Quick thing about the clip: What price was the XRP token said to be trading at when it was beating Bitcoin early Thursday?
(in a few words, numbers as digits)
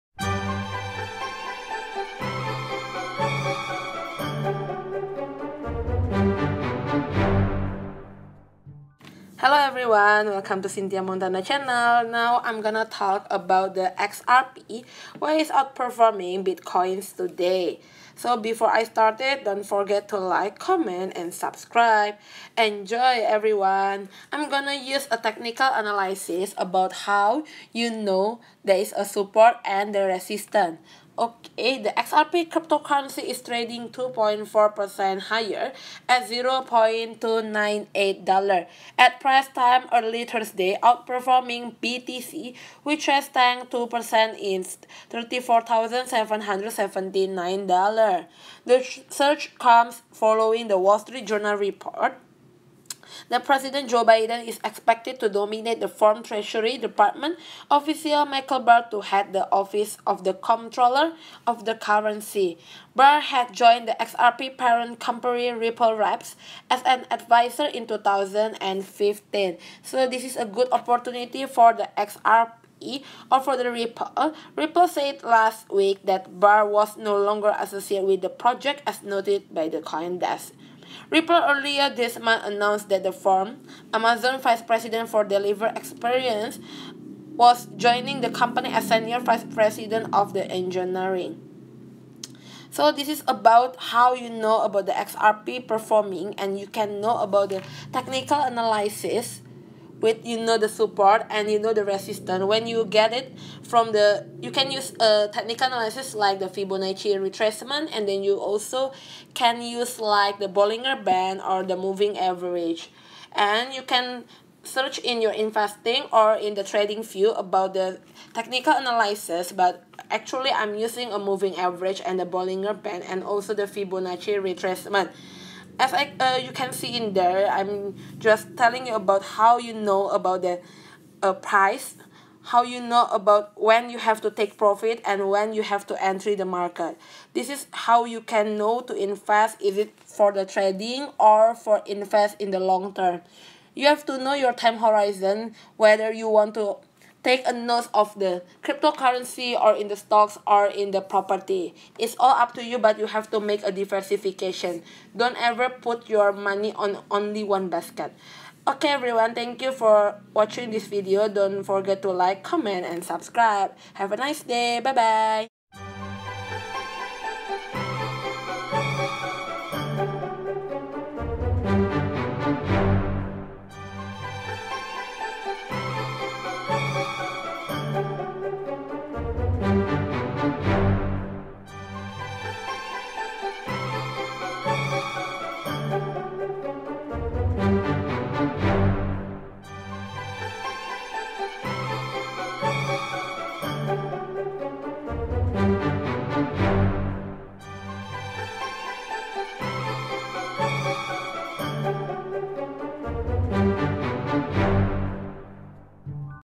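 $0.298.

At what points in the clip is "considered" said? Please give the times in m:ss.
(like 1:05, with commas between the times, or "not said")
not said.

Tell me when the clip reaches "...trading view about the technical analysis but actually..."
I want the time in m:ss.
1:56.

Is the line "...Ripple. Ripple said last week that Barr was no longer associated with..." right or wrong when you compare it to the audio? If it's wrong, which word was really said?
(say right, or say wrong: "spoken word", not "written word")
right.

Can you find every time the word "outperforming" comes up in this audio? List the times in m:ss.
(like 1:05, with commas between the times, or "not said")
0:15, 0:40.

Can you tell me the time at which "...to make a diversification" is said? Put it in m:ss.
2:33.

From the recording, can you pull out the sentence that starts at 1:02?
Barr had joined the XRP parent company Ripple Reps as an advisor in 2015.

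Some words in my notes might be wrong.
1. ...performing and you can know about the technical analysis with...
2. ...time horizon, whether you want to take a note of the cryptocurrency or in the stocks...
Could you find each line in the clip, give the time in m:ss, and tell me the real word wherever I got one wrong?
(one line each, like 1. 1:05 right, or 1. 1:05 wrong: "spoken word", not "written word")
1. 1:35 right
2. 2:24 right.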